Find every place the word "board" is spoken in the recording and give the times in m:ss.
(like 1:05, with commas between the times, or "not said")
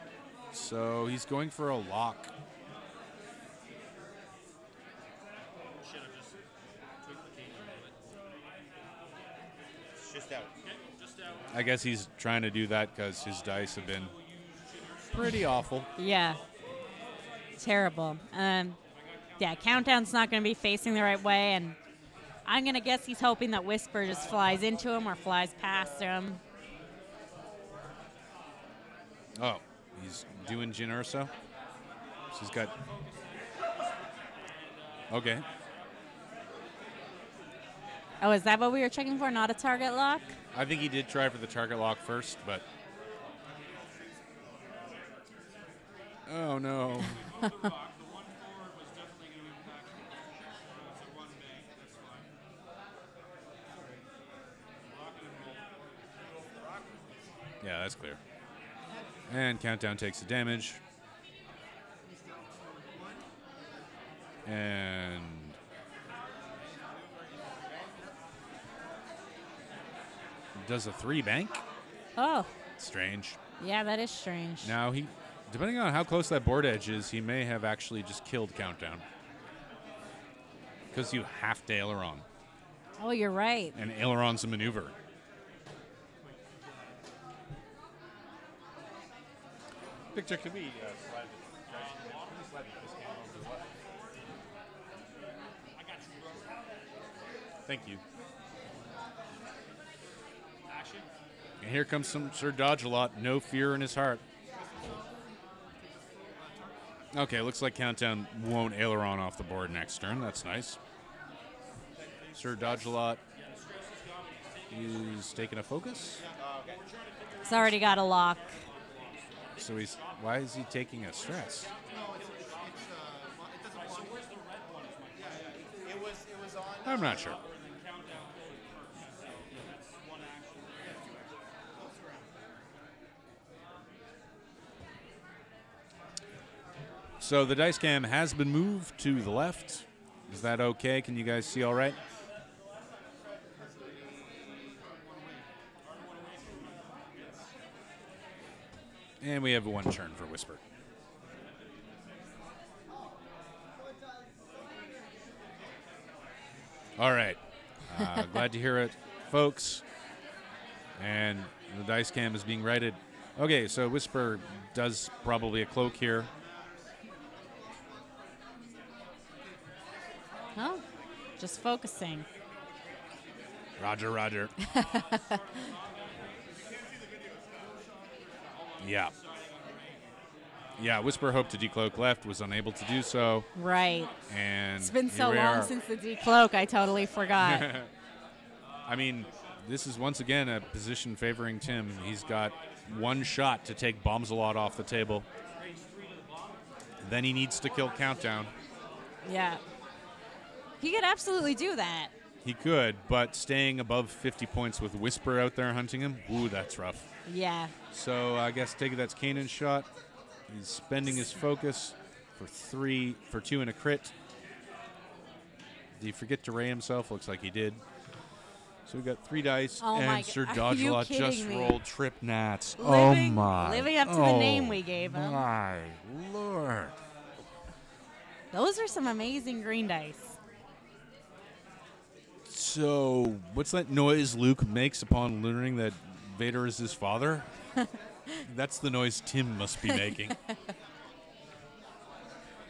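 1:16, 1:49.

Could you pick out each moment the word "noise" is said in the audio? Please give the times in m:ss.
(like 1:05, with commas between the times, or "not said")
3:53, 3:58.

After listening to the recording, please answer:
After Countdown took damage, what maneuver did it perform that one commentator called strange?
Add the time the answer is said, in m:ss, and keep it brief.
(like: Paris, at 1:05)
Three bank, at 1:10.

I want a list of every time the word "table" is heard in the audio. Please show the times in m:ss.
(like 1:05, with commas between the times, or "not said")
3:14.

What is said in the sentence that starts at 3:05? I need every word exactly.
since the Decloak, I totally forgot.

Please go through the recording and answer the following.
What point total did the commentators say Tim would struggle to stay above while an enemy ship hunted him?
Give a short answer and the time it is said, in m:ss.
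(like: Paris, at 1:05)
50, at 3:24.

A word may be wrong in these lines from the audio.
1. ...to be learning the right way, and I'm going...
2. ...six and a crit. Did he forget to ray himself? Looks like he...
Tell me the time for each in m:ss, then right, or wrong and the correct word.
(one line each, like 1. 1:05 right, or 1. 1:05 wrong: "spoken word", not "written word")
1. 0:20 wrong: "facing", not "learning"
2. 3:33 wrong: "two", not "six".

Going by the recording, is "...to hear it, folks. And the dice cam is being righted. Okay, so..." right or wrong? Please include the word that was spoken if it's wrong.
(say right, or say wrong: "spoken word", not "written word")
right.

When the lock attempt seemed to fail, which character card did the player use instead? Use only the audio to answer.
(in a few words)
Jyn Erso.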